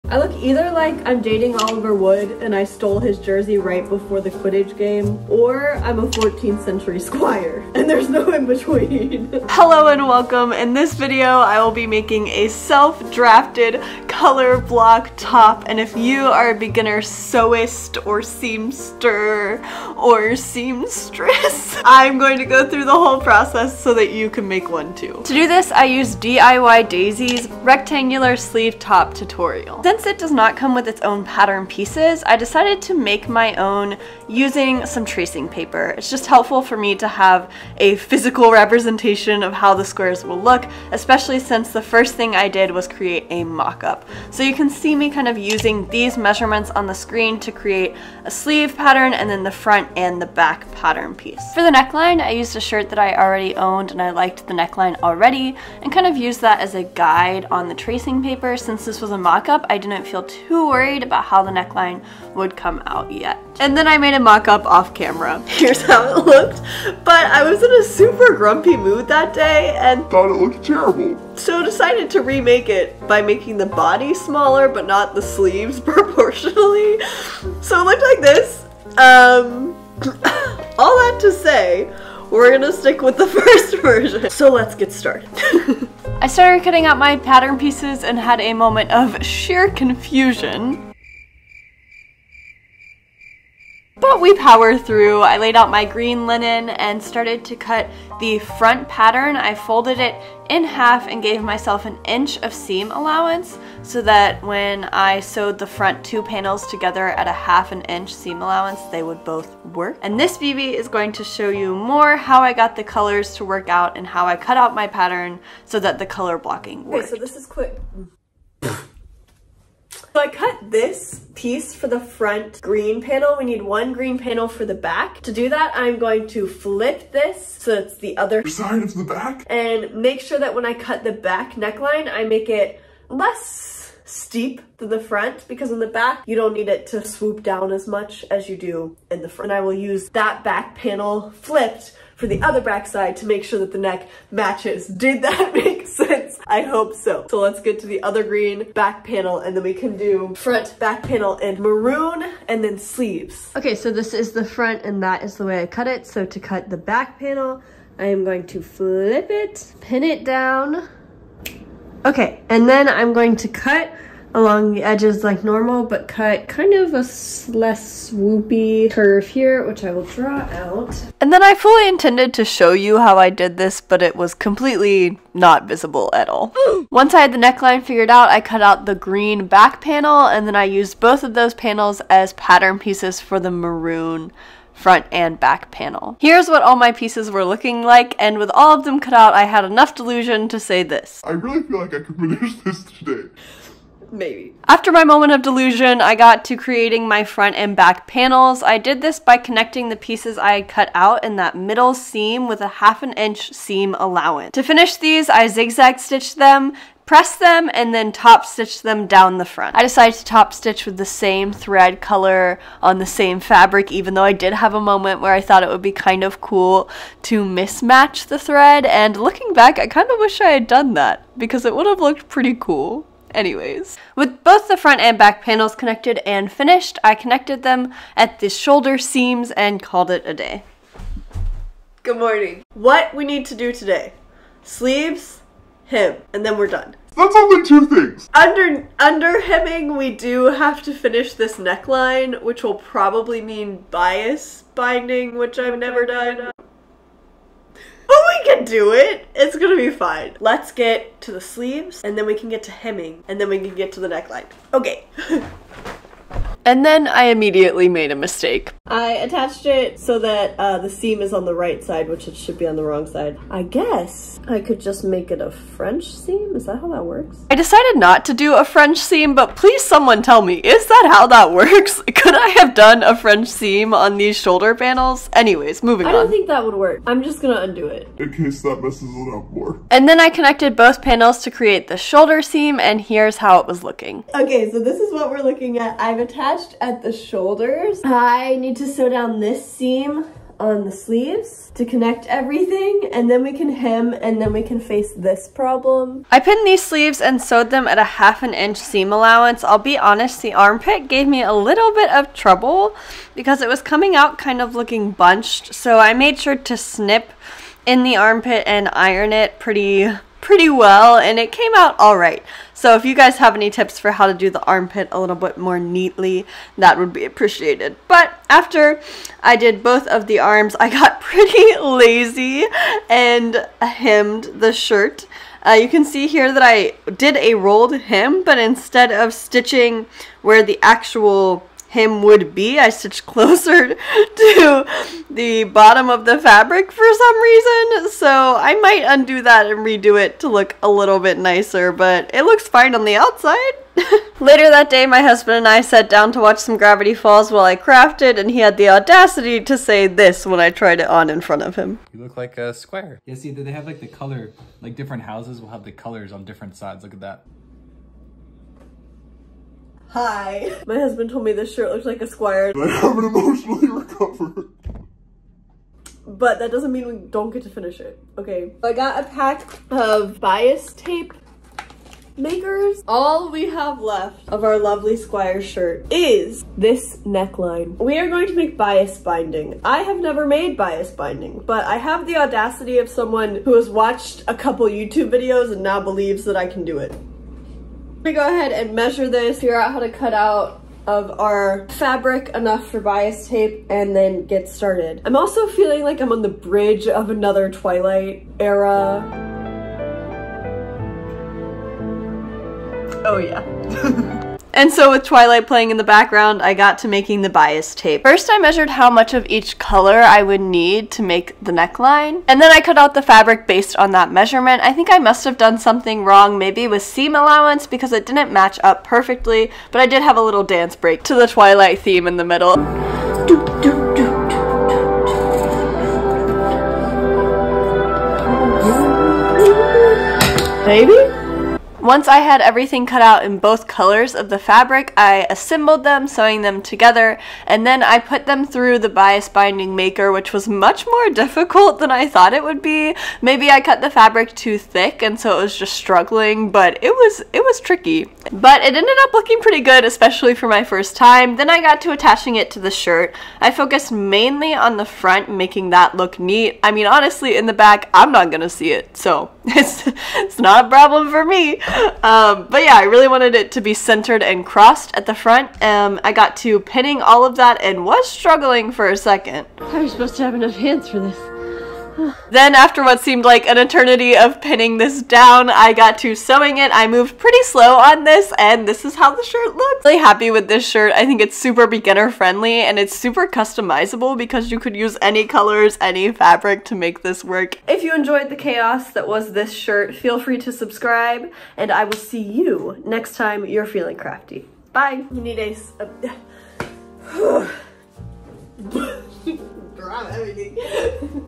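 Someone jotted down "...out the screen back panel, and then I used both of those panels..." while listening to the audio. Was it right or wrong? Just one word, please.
wrong.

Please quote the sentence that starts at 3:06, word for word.
Here's what all my pieces were looking like, and with all of them cut out, I had enough delusion to say this.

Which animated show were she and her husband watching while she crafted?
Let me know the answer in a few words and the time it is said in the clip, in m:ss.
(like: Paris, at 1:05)
Gravity Falls, at 5:46.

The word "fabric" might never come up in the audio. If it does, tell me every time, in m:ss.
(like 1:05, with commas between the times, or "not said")
3:33, 5:36, 6:31, 6:53, 7:14, 7:24, 8:06.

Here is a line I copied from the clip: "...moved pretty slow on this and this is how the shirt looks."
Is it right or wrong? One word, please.
right.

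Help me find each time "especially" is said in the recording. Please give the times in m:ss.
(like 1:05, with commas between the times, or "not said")
0:40, 7:30.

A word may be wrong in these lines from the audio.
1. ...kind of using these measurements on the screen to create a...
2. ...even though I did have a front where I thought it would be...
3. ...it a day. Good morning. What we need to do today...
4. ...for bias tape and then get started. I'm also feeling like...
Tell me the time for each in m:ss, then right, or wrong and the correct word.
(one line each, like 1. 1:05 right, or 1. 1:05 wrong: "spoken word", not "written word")
1. 0:45 right
2. 3:33 wrong: "moment", not "front"
3. 3:50 right
4. 6:32 right.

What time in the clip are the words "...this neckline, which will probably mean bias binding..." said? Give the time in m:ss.
4:01.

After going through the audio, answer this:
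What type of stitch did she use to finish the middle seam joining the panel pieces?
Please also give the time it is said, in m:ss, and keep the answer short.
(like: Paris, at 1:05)
zigzag, at 3:25.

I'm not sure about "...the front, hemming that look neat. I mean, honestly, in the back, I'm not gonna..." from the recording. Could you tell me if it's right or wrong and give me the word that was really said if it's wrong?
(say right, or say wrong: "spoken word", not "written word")
wrong: "making", not "hemming".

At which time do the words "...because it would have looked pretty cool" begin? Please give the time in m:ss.
3:41.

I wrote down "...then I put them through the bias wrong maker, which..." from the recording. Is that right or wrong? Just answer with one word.
wrong.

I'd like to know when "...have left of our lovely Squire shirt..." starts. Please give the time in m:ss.
6:13.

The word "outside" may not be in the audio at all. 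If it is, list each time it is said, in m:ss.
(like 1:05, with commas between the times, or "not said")
5:43.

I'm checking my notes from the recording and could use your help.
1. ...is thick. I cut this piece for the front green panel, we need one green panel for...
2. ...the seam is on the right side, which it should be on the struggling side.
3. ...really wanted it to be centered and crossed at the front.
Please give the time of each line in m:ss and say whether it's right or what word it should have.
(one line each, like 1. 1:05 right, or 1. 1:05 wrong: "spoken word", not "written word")
1. 1:57 wrong: "quick", not "thick"
2. 4:20 wrong: "wrong", not "struggling"
3. 7:43 right.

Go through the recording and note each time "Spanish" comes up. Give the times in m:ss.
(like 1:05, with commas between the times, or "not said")
not said.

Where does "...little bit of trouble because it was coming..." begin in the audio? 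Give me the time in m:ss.
5:01.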